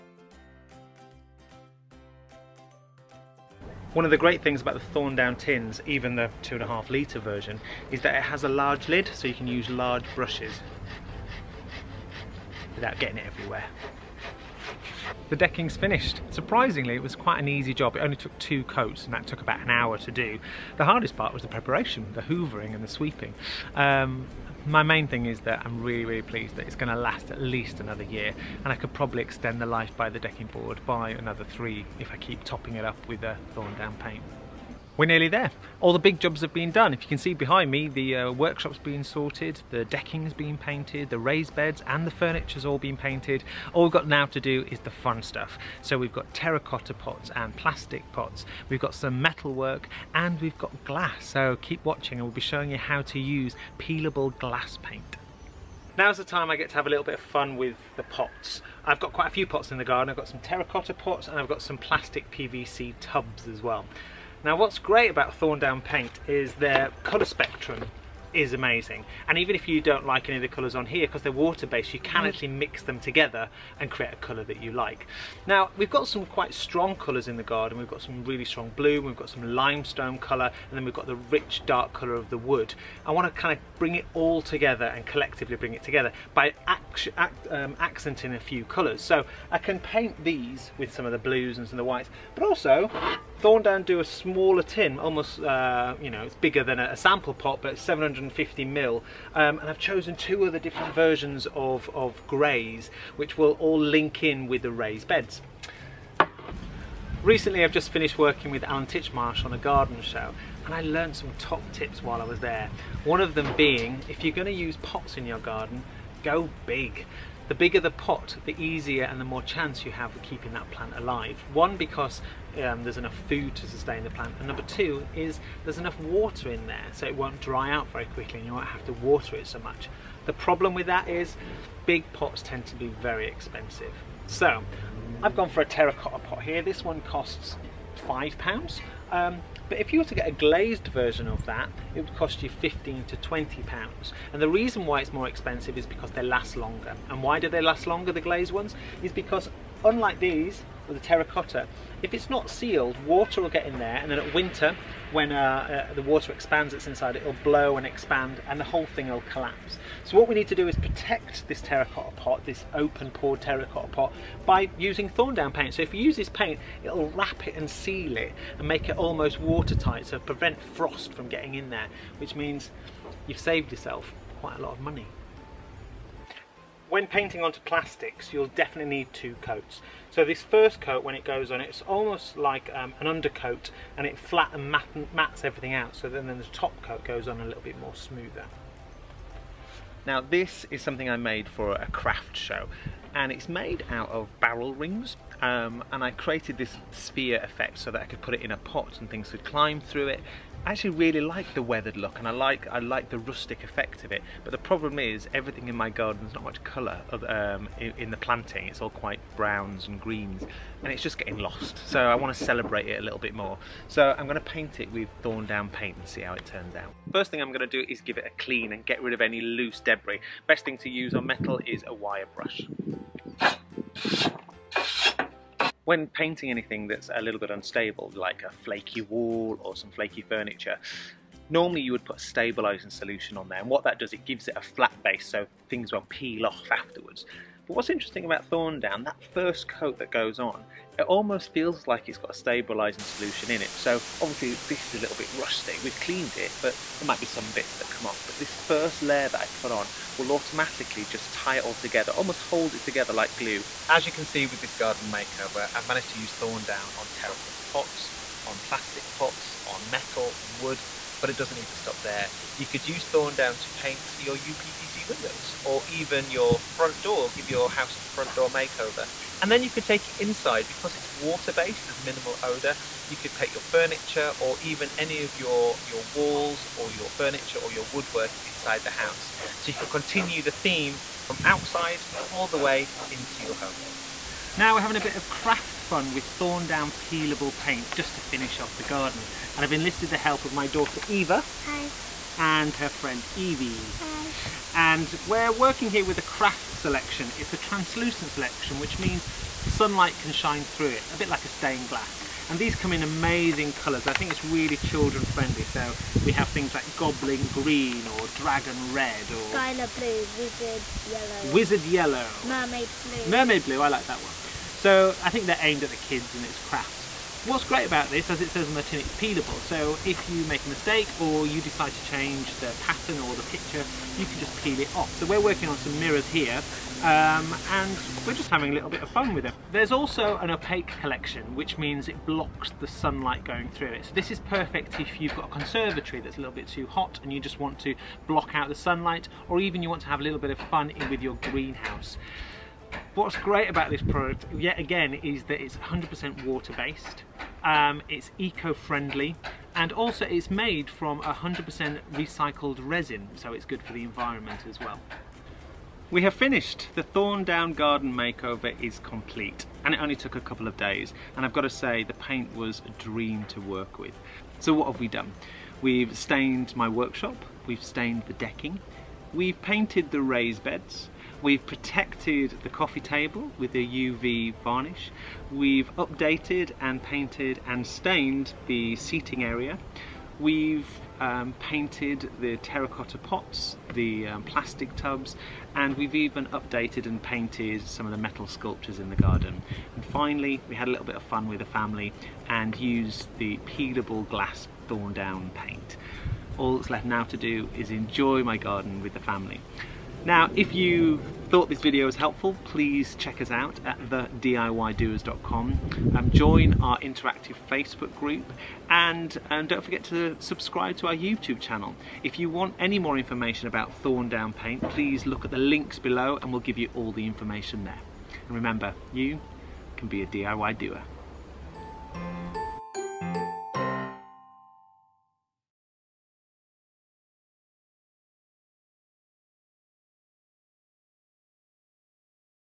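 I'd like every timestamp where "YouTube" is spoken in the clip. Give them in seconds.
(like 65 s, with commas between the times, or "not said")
411 s.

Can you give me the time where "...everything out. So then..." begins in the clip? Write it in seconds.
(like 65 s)
185 s.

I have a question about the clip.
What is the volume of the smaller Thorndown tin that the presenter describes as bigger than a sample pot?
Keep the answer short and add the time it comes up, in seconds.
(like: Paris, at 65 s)
750 ml, at 97 s.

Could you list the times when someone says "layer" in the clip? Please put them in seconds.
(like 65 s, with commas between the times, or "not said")
249 s.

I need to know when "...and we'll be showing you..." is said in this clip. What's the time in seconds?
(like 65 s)
52 s.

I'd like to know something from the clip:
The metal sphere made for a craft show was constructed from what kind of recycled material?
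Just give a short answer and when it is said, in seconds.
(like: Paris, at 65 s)
Barrel rings, at 194 s.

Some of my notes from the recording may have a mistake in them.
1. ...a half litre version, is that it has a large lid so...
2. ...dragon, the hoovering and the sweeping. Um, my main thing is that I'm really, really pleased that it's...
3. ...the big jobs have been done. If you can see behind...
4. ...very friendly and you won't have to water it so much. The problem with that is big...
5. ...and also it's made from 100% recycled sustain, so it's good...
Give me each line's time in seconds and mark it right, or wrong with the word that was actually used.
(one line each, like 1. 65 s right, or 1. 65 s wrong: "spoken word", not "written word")
1. 6 s right
2. 21 s wrong: "preparation", not "dragon"
3. 35 s right
4. 127 s wrong: "quickly", not "friendly"
5. 349 s wrong: "resin", not "sustain".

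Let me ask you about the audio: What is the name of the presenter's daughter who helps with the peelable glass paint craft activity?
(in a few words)
Eva.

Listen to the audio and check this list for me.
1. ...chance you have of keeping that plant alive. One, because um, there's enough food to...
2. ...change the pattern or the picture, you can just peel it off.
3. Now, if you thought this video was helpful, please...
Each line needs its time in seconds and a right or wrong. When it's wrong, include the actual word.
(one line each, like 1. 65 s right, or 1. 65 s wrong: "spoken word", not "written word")
1. 119 s right
2. 322 s right
3. 400 s right.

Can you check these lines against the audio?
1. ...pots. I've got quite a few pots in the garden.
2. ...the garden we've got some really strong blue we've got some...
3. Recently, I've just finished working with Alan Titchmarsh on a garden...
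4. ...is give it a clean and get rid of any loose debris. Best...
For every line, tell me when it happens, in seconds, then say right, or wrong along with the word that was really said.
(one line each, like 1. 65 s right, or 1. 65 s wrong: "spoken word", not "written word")
1. 58 s right
2. 77 s right
3. 107 s right
4. 217 s right.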